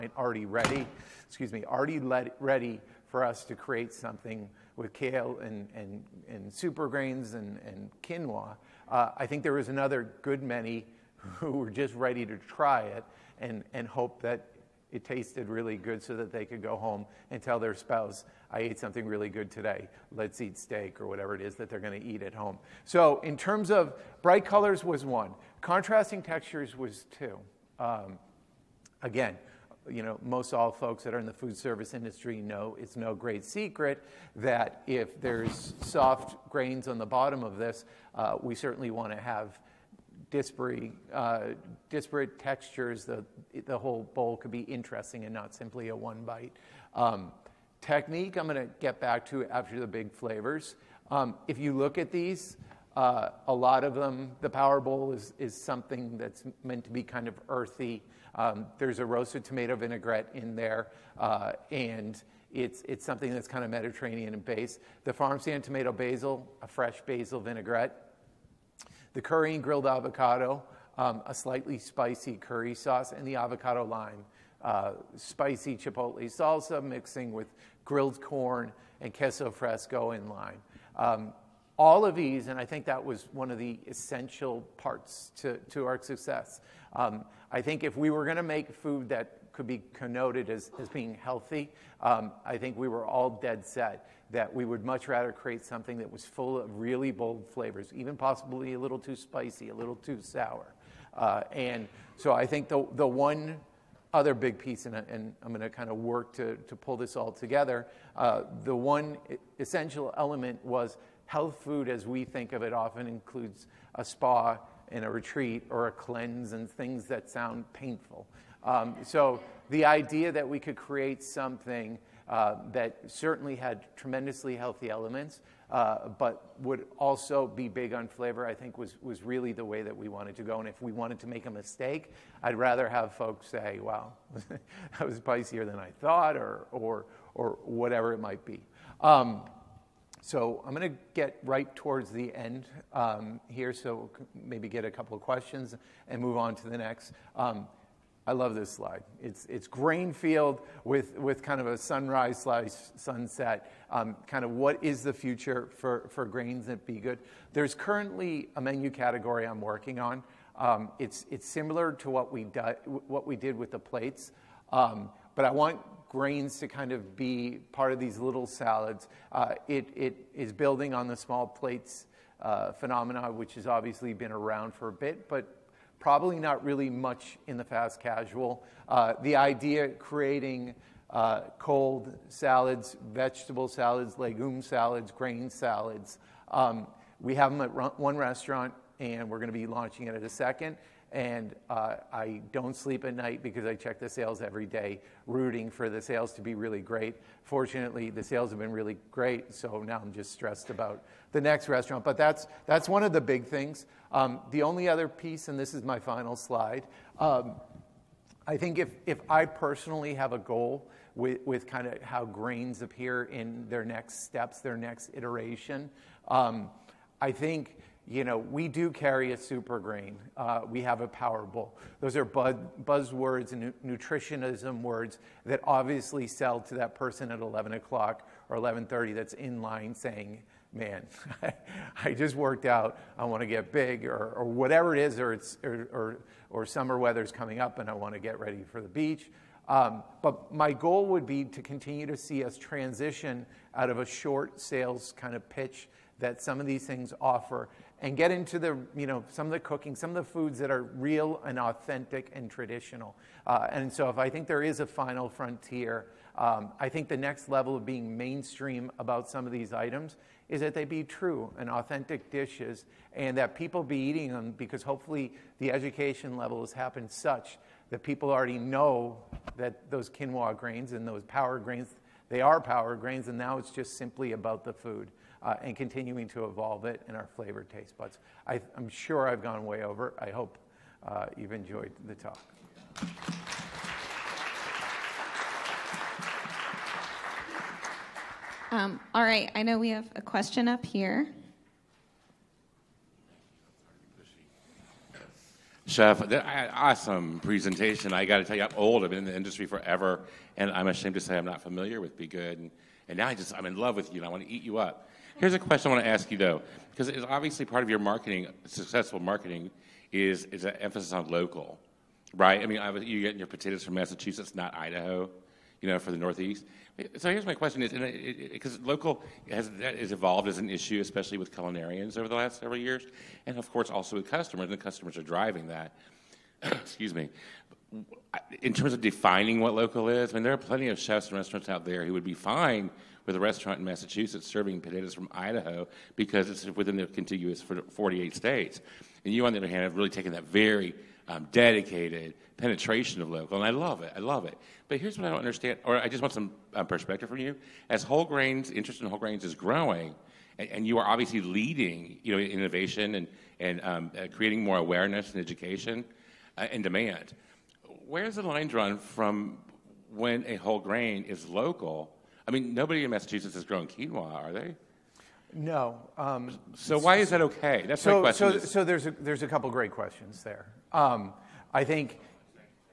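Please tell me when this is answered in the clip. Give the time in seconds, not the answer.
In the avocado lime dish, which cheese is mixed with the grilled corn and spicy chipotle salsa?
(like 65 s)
79 s.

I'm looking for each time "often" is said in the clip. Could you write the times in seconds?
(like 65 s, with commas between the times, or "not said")
112 s.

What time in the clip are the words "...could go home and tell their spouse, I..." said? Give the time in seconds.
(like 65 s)
16 s.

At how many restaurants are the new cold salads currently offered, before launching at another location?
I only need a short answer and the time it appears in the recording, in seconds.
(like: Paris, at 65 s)
1, at 187 s.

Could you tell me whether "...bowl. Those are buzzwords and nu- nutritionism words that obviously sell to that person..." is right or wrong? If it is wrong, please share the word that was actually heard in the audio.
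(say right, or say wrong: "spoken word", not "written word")
right.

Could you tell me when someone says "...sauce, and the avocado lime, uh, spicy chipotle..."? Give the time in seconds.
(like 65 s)
72 s.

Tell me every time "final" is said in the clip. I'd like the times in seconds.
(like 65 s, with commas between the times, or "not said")
205 s, 254 s.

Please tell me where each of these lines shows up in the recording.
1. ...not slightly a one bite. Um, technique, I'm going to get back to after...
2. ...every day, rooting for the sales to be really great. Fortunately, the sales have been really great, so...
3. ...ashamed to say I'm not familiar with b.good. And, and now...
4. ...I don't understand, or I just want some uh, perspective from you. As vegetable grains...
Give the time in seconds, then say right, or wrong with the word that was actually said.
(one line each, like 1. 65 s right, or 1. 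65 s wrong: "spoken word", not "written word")
1. 45 s wrong: "simply", not "slightly"
2. 194 s right
3. 300 s right
4. 345 s wrong: "whole", not "vegetable".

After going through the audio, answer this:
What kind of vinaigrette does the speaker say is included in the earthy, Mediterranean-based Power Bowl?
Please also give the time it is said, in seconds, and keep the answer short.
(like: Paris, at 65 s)
Roasted tomato vinaigrette, at 59 s.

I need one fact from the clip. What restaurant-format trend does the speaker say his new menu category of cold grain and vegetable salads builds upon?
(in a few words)
Small plates.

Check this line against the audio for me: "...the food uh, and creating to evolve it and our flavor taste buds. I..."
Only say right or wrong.
wrong.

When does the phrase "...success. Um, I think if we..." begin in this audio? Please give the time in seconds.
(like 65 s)
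86 s.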